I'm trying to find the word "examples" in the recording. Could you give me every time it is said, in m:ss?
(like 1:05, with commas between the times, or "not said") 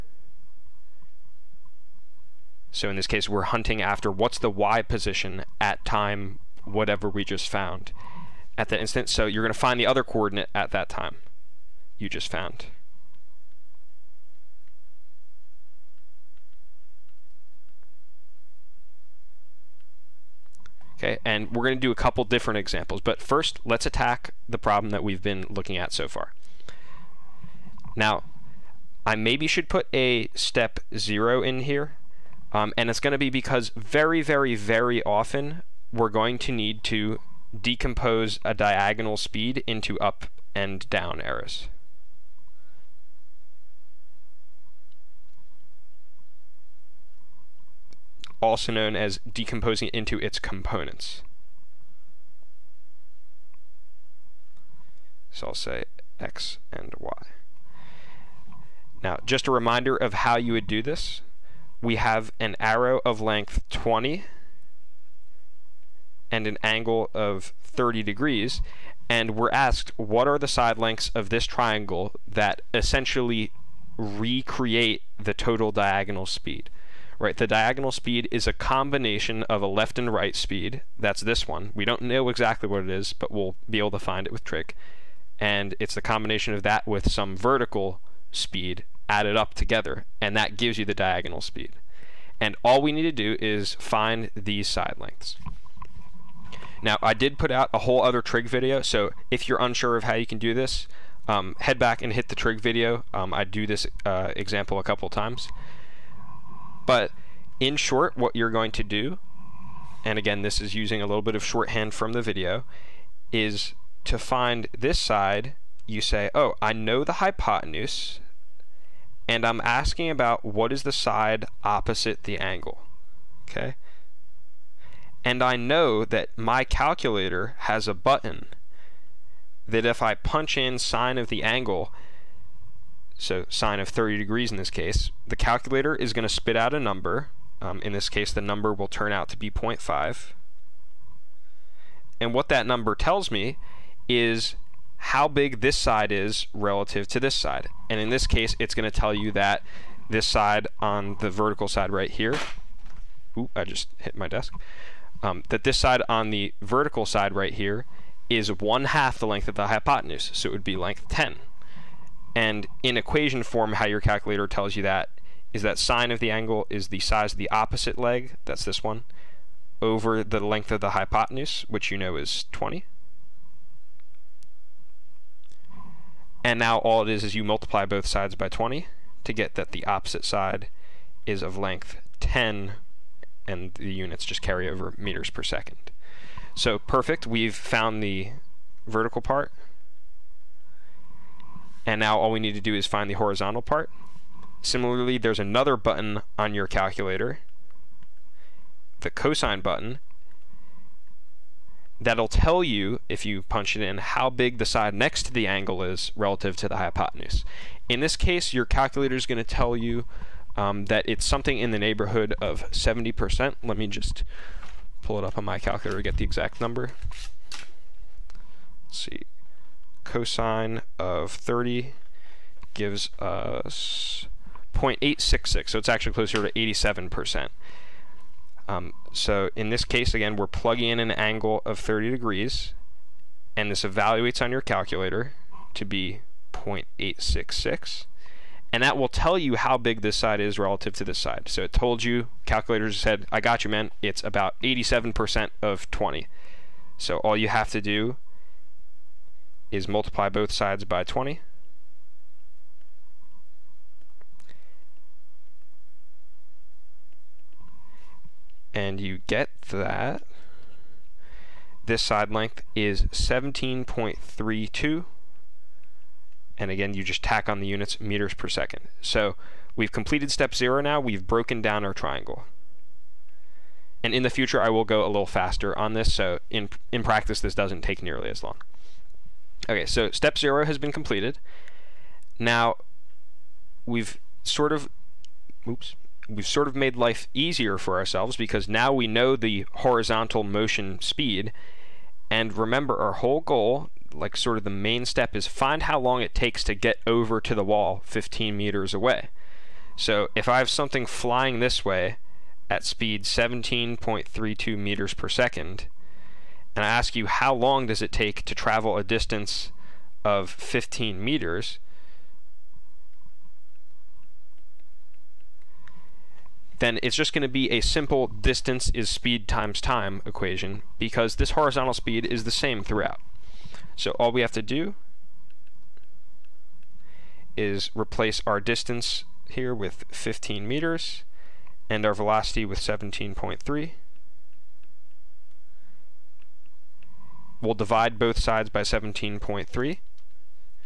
0:22, 1:44.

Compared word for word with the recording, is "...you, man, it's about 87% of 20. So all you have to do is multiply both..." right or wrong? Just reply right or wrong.
right.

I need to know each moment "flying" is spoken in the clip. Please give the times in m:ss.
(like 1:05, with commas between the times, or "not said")
5:01.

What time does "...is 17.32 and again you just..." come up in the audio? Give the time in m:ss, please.
4:22.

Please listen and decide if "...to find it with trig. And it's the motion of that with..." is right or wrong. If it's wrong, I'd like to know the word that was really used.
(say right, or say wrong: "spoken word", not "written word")
wrong: "combination", not "motion".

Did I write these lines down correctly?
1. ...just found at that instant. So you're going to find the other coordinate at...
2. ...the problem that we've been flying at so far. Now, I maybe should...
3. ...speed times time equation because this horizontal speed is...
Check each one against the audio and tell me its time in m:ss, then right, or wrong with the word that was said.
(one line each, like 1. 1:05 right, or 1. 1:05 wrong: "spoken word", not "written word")
1. 0:07 right
2. 0:24 wrong: "looking", not "flying"
3. 5:19 right.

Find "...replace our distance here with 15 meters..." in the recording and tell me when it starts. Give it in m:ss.
5:27.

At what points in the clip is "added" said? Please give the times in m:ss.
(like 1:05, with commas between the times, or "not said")
1:29.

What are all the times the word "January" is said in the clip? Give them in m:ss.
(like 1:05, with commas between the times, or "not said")
not said.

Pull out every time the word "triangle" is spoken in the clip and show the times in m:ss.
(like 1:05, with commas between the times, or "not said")
1:11, 4:31.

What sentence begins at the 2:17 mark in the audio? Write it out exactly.
Um, in this case, the number will turn out to be 0.5.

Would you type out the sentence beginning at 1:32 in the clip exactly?
And all we need to do is find these side lengths.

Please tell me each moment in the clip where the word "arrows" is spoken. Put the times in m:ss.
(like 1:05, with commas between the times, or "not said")
0:41, 1:02.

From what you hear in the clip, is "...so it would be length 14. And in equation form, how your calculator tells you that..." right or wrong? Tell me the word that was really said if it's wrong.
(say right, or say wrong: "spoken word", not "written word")
wrong: "10", not "14".